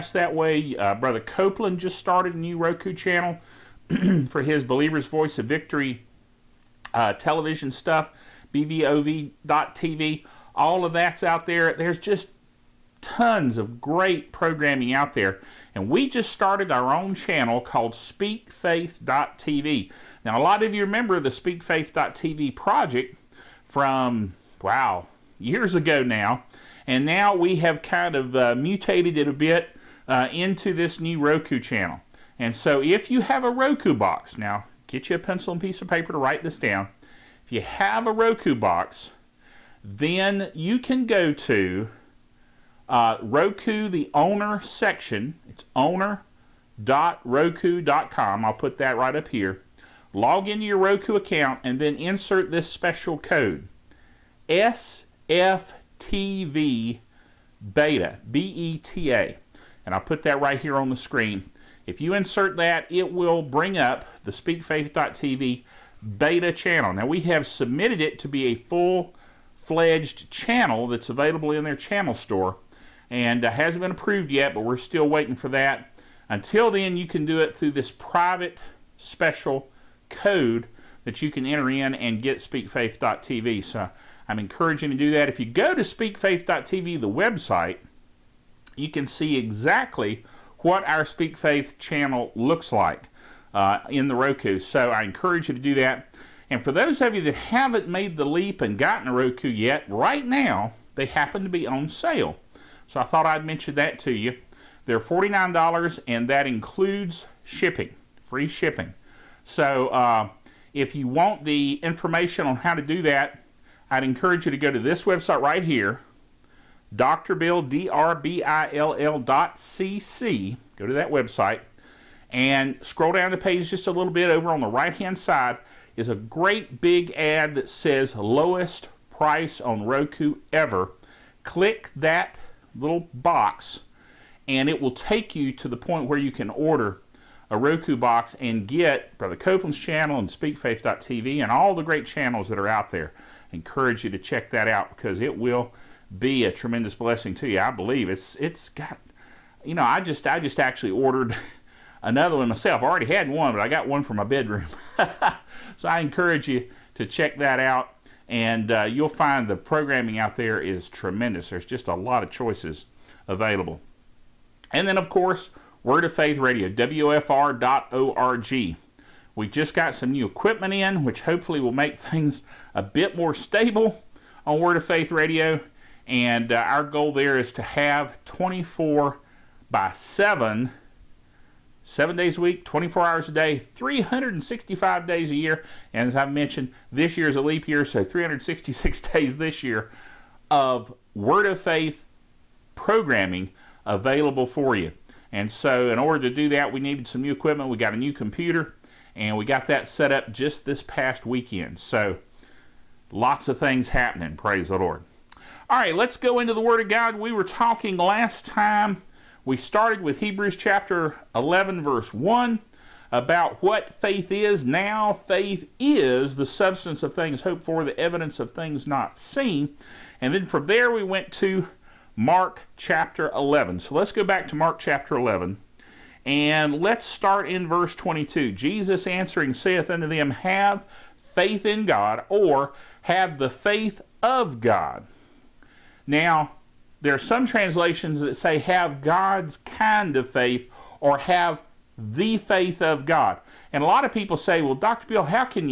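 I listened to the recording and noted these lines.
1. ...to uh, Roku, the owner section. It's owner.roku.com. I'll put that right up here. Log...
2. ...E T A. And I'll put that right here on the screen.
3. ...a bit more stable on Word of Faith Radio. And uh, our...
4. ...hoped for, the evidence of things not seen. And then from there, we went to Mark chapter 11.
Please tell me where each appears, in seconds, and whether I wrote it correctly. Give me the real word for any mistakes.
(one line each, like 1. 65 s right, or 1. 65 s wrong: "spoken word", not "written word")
1. 41 s right
2. 58 s right
3. 172 s right
4. 217 s right.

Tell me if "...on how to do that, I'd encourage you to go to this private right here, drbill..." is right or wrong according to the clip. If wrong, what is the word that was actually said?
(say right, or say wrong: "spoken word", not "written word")
wrong: "website", not "private".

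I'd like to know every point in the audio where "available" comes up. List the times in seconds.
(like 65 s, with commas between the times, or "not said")
71 s, 163 s, 193 s.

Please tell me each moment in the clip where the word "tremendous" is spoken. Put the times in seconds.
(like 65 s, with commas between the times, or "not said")
146 s, 160 s.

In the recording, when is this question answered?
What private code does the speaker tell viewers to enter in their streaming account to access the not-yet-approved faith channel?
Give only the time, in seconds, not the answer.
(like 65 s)
54 s.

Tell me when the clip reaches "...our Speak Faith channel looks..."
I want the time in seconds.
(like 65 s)
90 s.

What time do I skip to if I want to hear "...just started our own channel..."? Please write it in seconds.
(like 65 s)
16 s.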